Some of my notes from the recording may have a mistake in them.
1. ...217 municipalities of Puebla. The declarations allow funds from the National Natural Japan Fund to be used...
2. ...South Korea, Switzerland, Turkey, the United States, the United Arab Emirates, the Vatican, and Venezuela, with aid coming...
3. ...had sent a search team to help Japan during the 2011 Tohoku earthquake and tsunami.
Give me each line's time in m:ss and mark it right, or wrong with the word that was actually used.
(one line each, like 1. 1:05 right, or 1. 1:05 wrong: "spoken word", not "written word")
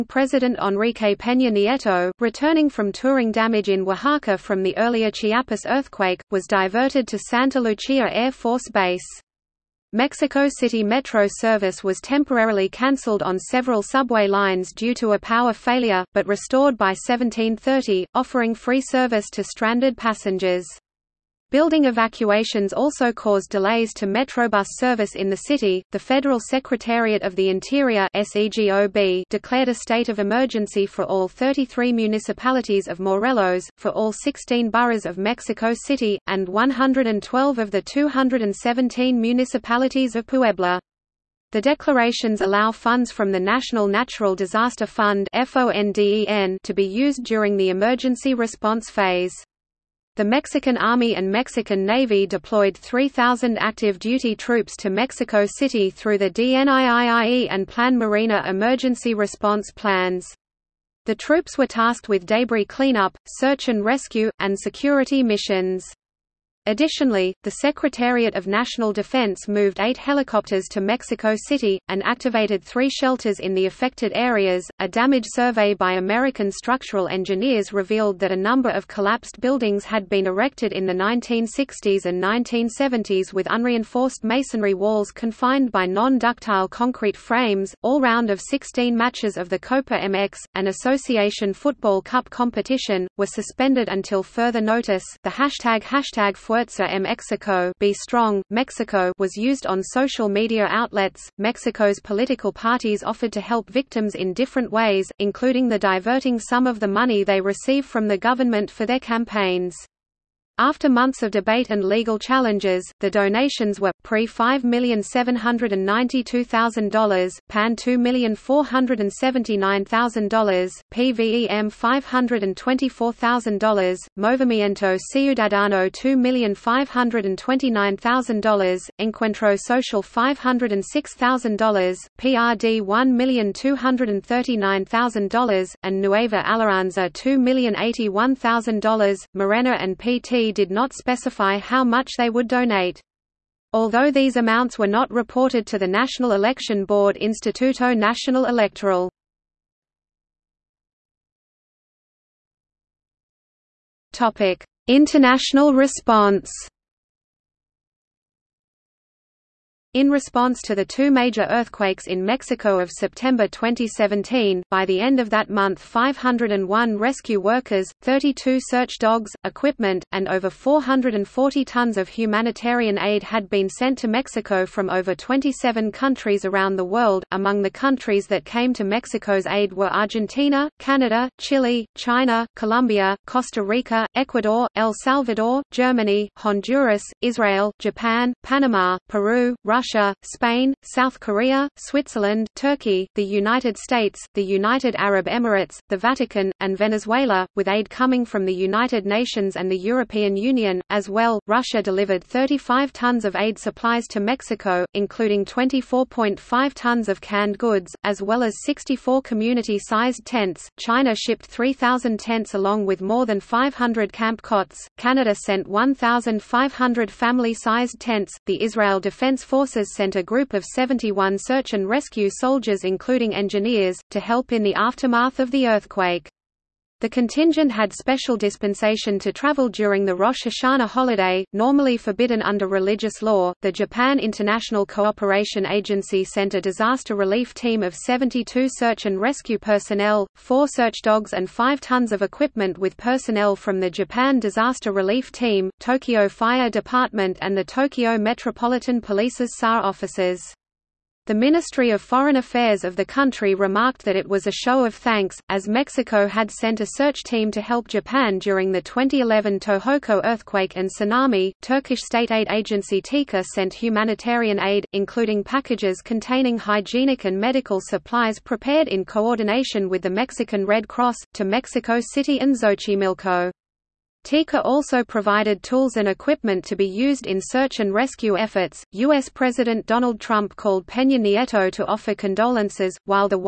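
1. 0:37 wrong: "Disaster", not "Japan"
2. 3:10 right
3. 4:16 right.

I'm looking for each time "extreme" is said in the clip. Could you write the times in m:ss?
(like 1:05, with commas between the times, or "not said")
not said.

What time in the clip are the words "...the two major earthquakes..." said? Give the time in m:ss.
2:40.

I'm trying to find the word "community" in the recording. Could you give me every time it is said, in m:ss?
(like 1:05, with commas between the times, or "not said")
3:29.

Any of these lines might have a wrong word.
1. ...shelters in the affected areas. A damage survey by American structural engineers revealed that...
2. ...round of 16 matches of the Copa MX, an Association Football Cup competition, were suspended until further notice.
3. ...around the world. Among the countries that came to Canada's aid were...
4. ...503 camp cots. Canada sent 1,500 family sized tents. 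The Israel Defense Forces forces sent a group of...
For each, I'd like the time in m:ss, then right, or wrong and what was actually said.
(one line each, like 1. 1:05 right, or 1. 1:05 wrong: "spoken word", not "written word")
1. 1:12 right
2. 1:28 right
3. 2:56 wrong: "Mexico", not "Canada"
4. 3:33 wrong: "500", not "503".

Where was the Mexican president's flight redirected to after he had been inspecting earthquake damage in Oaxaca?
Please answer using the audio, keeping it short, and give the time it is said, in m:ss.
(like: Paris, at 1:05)
Santa Lucia Air Force Base, at 0:07.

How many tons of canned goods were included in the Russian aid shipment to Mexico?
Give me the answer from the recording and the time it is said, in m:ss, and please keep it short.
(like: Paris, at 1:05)
24.5, at 3:25.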